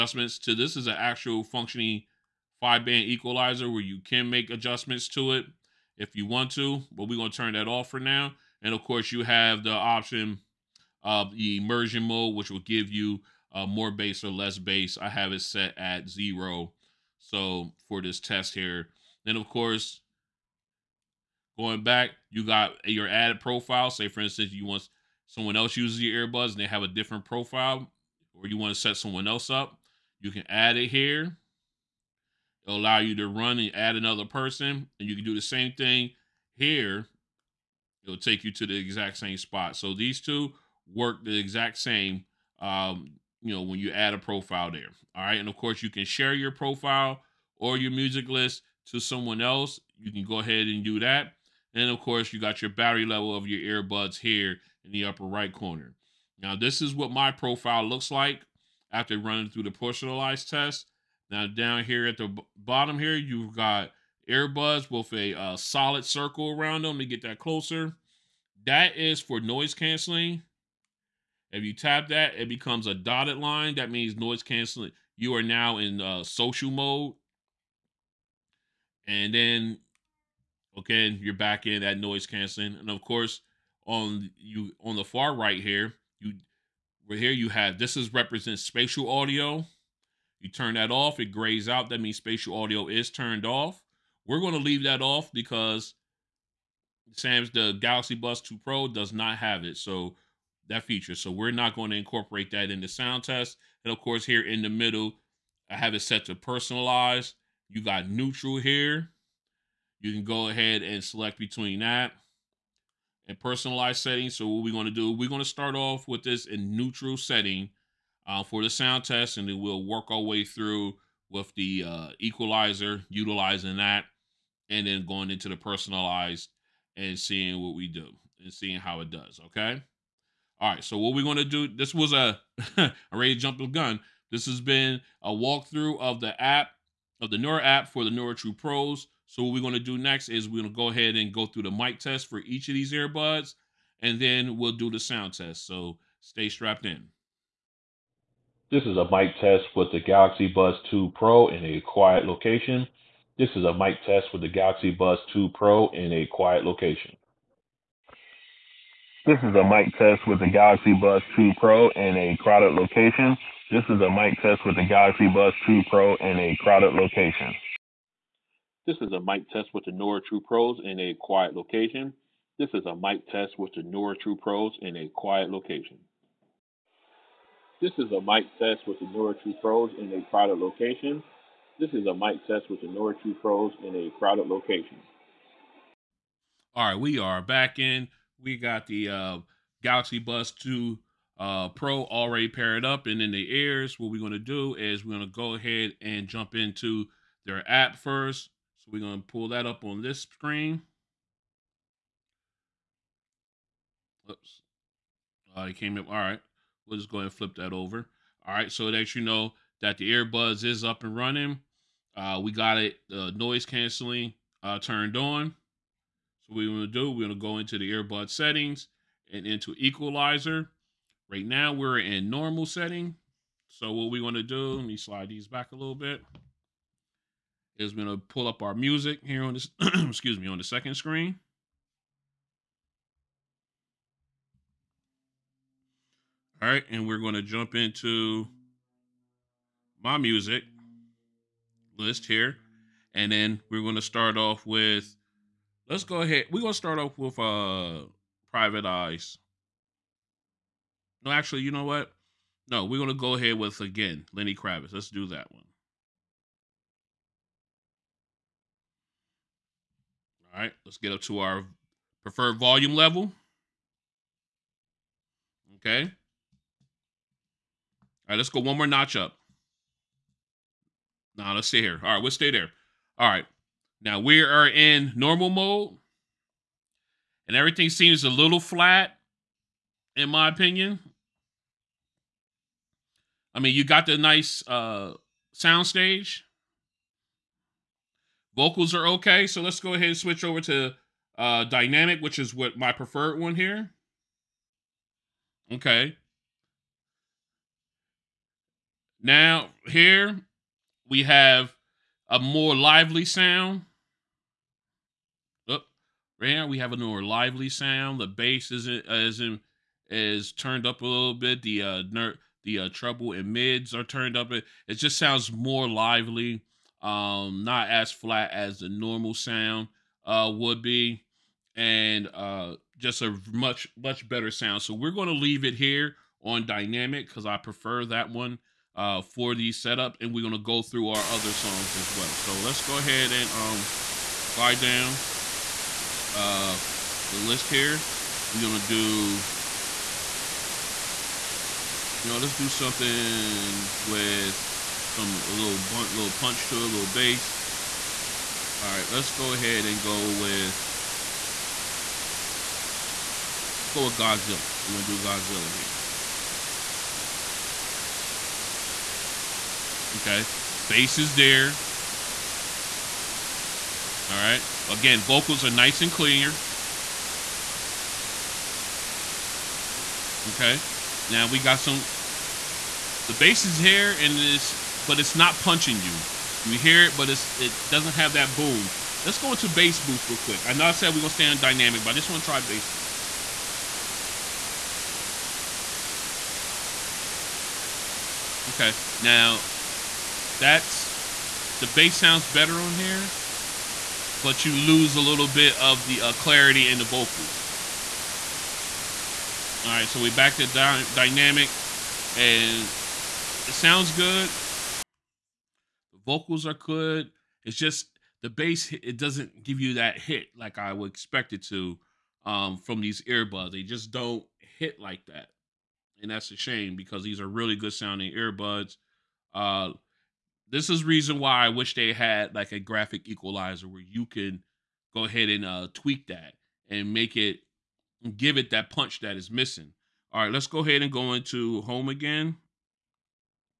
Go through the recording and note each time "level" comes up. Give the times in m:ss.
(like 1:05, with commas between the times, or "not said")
0:53, 4:22.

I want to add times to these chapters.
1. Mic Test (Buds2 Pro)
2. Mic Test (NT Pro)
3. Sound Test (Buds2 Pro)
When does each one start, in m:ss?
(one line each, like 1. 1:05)
1. 2:27
2. 2:47
3. 3:05.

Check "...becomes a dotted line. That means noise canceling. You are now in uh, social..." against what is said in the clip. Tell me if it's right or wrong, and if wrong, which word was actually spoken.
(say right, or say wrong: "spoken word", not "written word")
right.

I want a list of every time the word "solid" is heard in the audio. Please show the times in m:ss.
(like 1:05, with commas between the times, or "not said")
1:05.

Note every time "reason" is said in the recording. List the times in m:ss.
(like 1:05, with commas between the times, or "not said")
7:01.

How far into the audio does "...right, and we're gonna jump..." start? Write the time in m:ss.
3:56.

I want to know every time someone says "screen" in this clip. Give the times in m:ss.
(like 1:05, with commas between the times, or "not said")
3:20, 3:50.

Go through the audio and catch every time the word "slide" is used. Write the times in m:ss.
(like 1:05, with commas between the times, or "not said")
3:44, 5:34.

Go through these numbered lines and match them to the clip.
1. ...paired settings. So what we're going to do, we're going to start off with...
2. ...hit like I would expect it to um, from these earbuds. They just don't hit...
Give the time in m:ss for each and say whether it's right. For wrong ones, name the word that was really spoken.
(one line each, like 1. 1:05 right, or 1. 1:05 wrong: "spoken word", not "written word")
1. 1:53 wrong: "personalized", not "paired"
2. 6:50 right.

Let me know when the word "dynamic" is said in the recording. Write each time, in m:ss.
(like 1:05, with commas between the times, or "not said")
4:51, 5:26, 6:21, 6:41.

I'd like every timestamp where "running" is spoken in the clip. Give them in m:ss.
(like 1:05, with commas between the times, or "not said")
0:59, 3:31.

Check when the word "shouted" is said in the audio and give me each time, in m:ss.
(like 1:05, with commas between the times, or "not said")
not said.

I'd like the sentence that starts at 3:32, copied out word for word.
Uh, we got it uh, noise canceling uh, turned on.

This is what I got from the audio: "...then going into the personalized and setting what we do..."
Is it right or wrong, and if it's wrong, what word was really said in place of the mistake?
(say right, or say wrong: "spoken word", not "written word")
wrong: "seeing", not "setting".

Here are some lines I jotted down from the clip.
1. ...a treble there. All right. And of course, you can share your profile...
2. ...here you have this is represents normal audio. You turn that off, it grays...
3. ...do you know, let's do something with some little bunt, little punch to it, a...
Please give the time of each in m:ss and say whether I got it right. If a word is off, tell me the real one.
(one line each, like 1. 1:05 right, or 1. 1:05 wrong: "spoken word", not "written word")
1. 0:44 wrong: "profile", not "treble"
2. 1:27 wrong: "spatial", not "normal"
3. 5:38 right.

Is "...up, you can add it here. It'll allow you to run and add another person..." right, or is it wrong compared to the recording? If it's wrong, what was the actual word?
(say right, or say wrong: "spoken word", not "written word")
right.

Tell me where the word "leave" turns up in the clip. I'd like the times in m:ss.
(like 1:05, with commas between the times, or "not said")
1:34, 5:25.